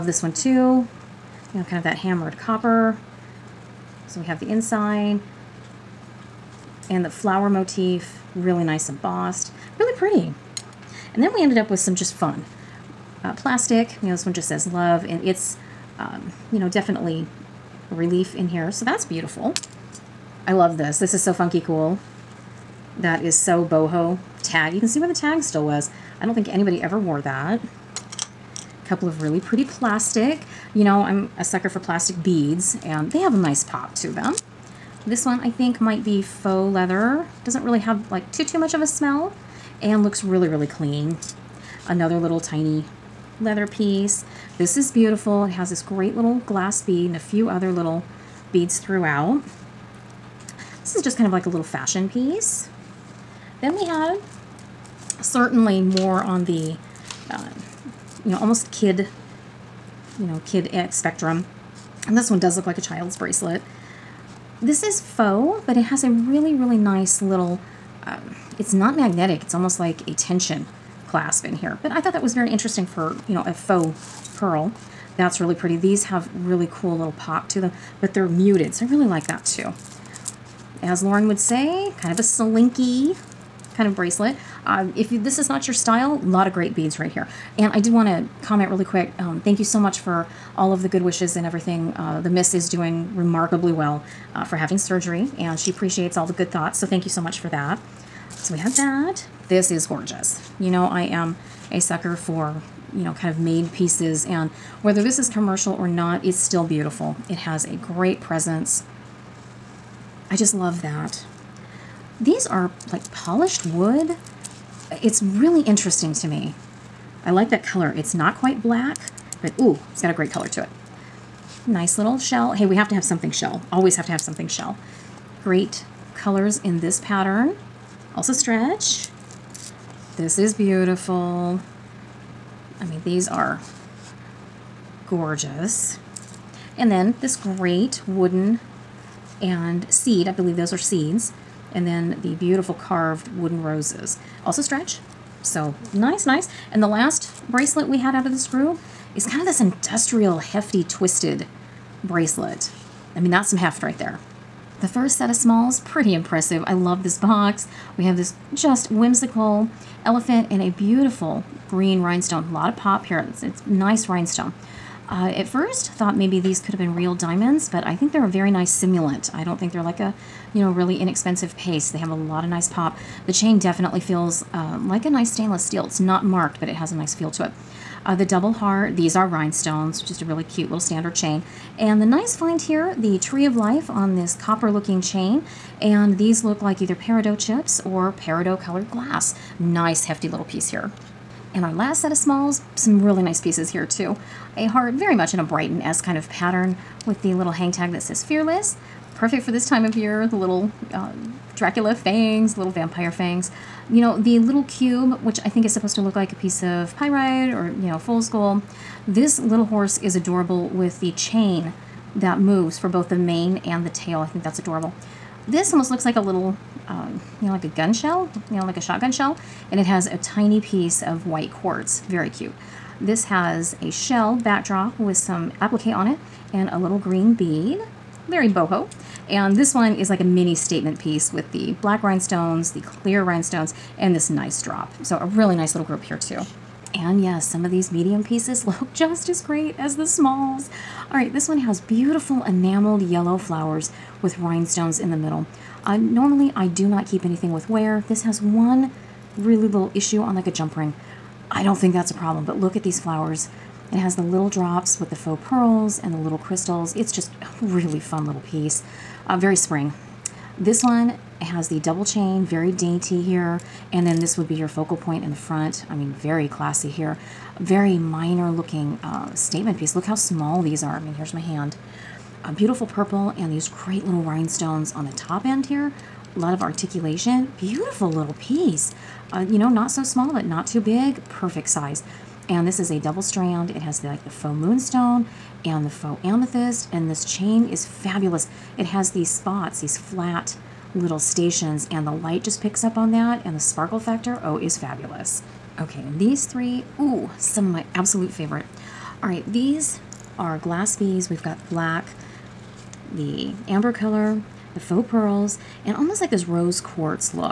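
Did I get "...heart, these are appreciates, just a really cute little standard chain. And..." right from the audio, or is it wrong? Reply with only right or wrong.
wrong.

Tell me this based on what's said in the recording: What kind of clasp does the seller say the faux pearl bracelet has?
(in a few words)
Tension clasp.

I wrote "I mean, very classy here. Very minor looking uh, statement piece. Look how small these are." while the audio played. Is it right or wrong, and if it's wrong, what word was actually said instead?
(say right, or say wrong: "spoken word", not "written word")
right.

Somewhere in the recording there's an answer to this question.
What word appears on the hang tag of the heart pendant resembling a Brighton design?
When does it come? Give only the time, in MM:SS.
03:18.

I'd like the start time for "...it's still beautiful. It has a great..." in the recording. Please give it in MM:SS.
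01:46.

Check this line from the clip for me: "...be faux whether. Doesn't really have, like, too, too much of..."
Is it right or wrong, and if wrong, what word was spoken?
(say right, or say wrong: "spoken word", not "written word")
wrong: "leather", not "whether".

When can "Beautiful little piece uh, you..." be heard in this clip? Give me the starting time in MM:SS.
04:37.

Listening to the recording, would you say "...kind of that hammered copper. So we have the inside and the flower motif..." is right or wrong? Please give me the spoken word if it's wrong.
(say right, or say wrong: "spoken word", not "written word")
right.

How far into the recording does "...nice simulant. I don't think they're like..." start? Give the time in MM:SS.
02:48.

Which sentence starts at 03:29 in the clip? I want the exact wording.
This little horse is adorable with the chain that moves for both the mane and the tail.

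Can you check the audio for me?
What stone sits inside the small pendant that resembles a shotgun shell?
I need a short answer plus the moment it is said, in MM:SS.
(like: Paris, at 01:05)
White quartz, at 03:41.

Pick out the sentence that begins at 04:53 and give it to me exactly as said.
And the sparkle factor, oh, is fabulous.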